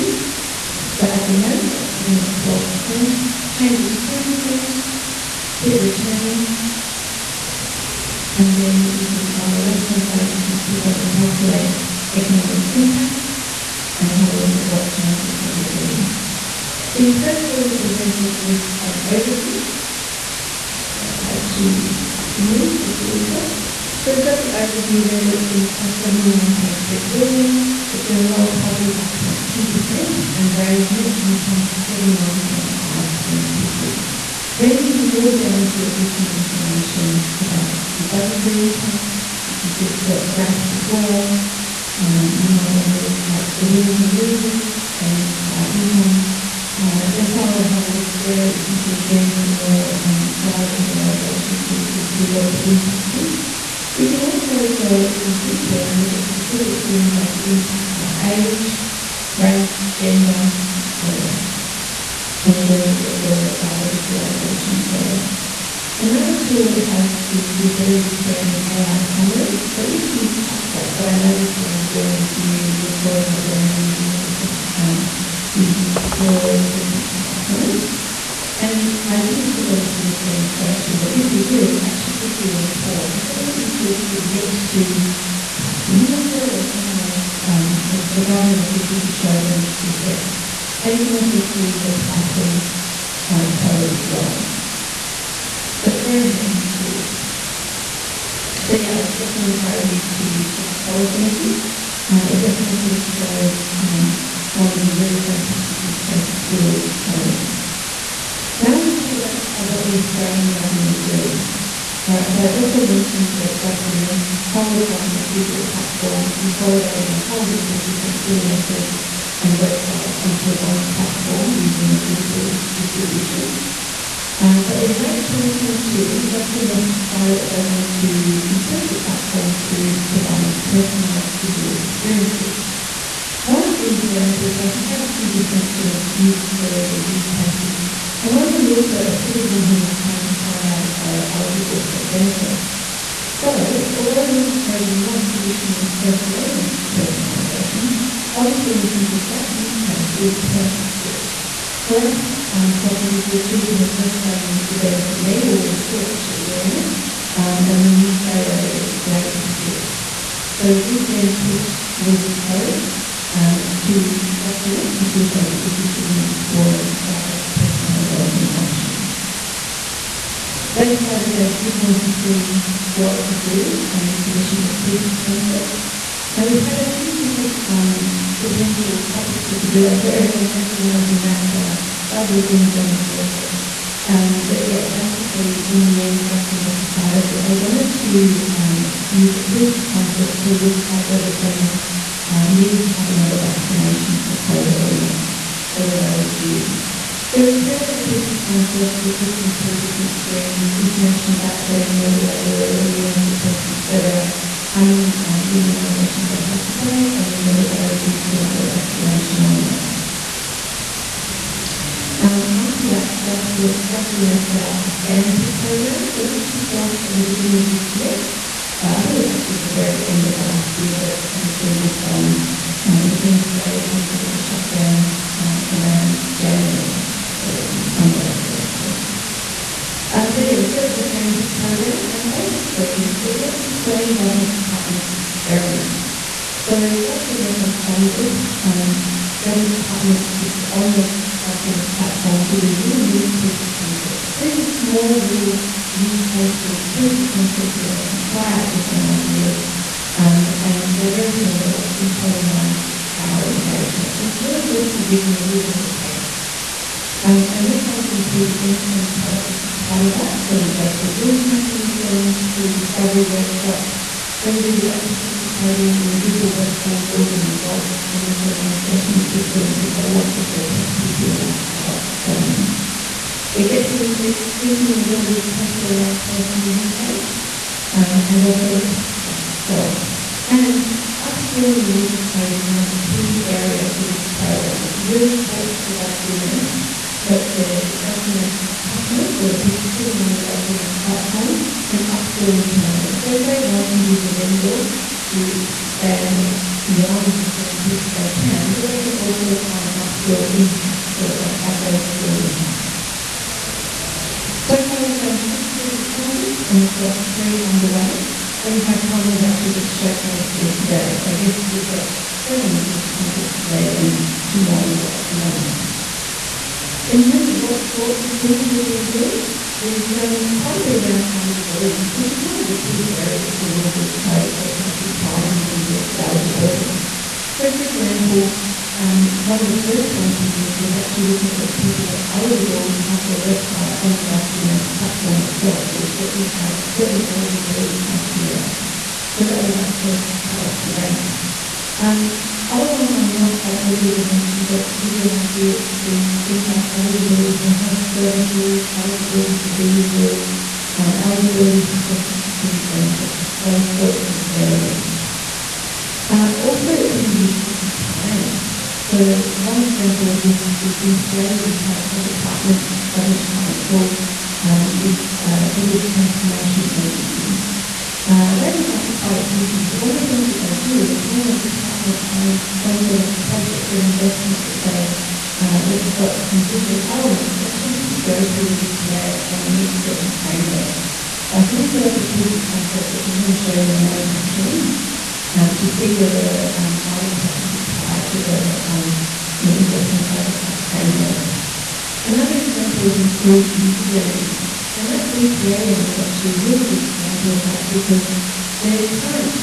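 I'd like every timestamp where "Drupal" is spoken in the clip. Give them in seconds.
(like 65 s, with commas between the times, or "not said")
122 s, 266 s.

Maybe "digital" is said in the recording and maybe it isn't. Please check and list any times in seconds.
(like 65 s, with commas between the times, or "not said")
115 s, 131 s, 153 s, 365 s, 376 s.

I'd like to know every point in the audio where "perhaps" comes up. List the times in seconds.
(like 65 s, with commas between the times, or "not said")
85 s.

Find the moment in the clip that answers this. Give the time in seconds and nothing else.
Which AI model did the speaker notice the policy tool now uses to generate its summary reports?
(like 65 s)
75 s.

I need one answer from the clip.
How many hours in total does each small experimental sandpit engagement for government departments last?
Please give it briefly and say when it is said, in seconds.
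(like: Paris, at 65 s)
96, at 252 s.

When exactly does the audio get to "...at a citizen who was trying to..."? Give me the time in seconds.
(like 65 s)
138 s.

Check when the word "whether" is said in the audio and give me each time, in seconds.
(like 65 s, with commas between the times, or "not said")
191 s, 195 s, 202 s, 207 s, 331 s, 386 s.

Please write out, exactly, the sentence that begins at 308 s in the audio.
And in fact, one was actually just showcased yesterday.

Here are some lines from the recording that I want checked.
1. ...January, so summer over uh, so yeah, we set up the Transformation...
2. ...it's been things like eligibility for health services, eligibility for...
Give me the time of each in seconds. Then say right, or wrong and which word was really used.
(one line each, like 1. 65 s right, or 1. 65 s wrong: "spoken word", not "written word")
1. 226 s wrong: "SAMP", not "Transformation"
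2. 345 s right.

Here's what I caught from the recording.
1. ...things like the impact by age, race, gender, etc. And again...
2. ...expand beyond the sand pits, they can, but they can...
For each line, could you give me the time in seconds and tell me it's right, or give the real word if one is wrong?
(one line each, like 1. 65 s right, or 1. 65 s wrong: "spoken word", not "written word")
1. 56 s right
2. 295 s right.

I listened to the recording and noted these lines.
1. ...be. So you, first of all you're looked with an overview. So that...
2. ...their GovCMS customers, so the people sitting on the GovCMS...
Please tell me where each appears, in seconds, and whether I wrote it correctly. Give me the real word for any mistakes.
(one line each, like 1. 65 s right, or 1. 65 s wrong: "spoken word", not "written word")
1. 15 s wrong: "presented", not "looked"
2. 287 s right.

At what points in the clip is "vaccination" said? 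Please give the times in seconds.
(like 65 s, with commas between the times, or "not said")
193 s, 208 s.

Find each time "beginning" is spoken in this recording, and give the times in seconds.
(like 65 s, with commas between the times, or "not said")
217 s.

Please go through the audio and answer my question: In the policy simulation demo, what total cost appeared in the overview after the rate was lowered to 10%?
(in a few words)
79.3 billion.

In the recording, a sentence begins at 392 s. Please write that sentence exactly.
Another example is improved user journeys.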